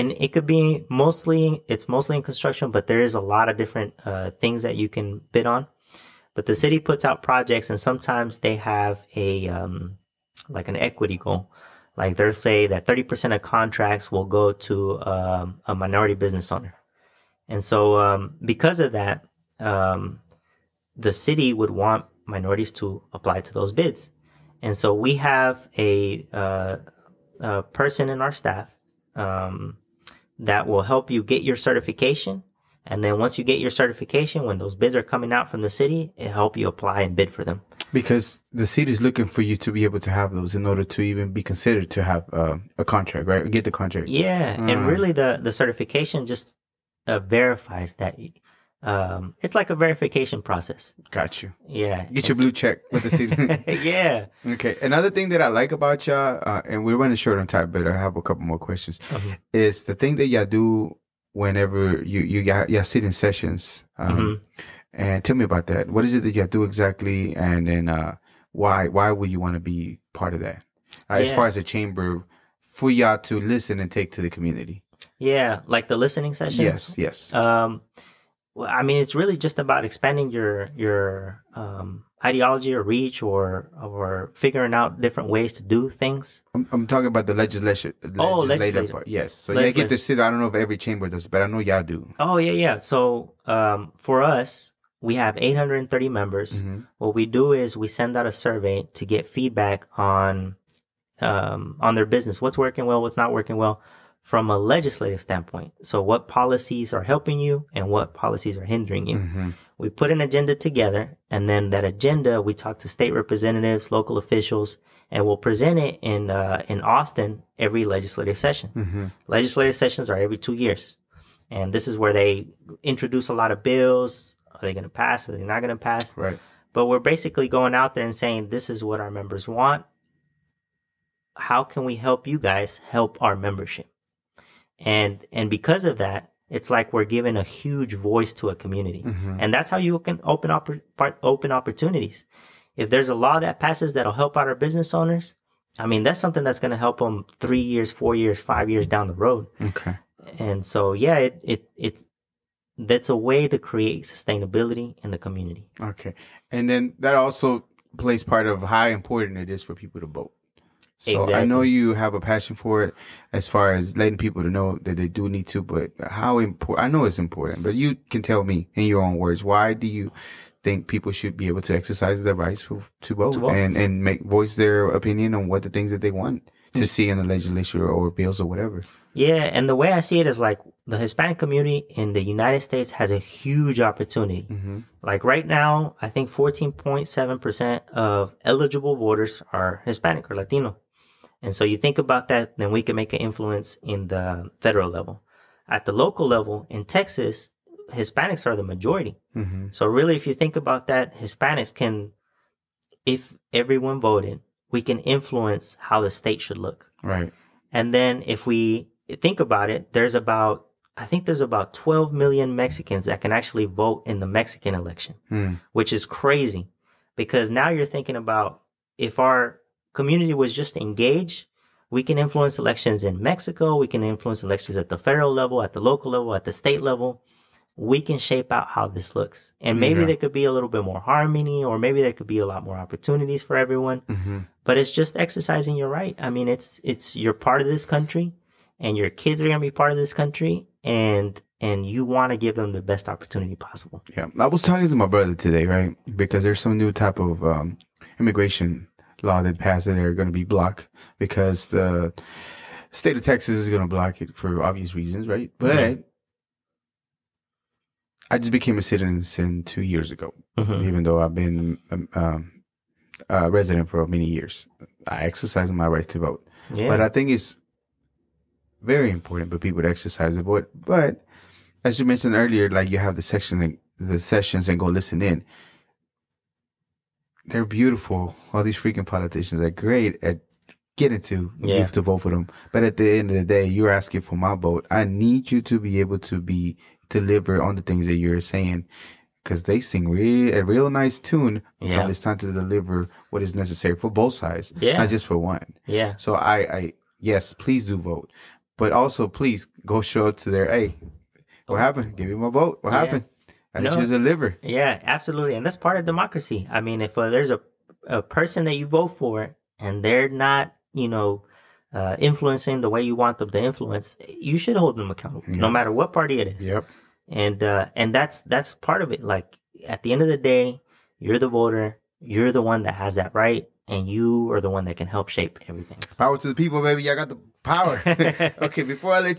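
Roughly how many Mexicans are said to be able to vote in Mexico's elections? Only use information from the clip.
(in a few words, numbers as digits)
12 million.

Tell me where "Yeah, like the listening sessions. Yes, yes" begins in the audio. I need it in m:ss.
1:15.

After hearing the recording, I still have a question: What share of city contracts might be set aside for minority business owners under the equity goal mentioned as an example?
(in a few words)
30%.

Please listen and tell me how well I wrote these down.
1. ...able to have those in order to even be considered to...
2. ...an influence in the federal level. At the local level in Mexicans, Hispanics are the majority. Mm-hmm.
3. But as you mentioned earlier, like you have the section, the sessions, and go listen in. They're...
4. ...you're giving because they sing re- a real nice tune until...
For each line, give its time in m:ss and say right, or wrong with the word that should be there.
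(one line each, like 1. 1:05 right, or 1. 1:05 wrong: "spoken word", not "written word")
1. 0:39 right
2. 3:13 wrong: "Texas", not "Mexicans"
3. 4:30 right
4. 4:48 wrong: "saying", not "giving".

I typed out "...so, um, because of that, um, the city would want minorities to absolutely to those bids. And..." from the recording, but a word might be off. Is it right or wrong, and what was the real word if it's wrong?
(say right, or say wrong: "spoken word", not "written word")
wrong: "apply", not "absolutely".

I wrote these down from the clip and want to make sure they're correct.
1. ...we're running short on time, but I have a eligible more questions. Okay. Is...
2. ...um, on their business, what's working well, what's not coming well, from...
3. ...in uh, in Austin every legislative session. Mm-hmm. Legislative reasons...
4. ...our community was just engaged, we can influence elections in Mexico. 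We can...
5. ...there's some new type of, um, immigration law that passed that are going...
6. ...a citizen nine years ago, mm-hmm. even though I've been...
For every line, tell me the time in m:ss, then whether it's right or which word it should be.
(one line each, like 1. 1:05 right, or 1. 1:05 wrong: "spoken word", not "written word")
1. 0:56 wrong: "couple", not "eligible"
2. 1:41 wrong: "working", not "coming"
3. 1:56 wrong: "sessions", not "reasons"
4. 3:39 right
5. 4:06 right
6. 4:18 wrong: "two", not "nine".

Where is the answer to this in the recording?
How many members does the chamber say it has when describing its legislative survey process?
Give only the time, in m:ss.
1:35.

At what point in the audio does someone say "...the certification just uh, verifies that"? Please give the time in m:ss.
0:45.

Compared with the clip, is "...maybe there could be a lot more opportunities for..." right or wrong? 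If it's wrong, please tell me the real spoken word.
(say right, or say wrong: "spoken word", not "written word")
right.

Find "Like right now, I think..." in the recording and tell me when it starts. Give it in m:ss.
3:05.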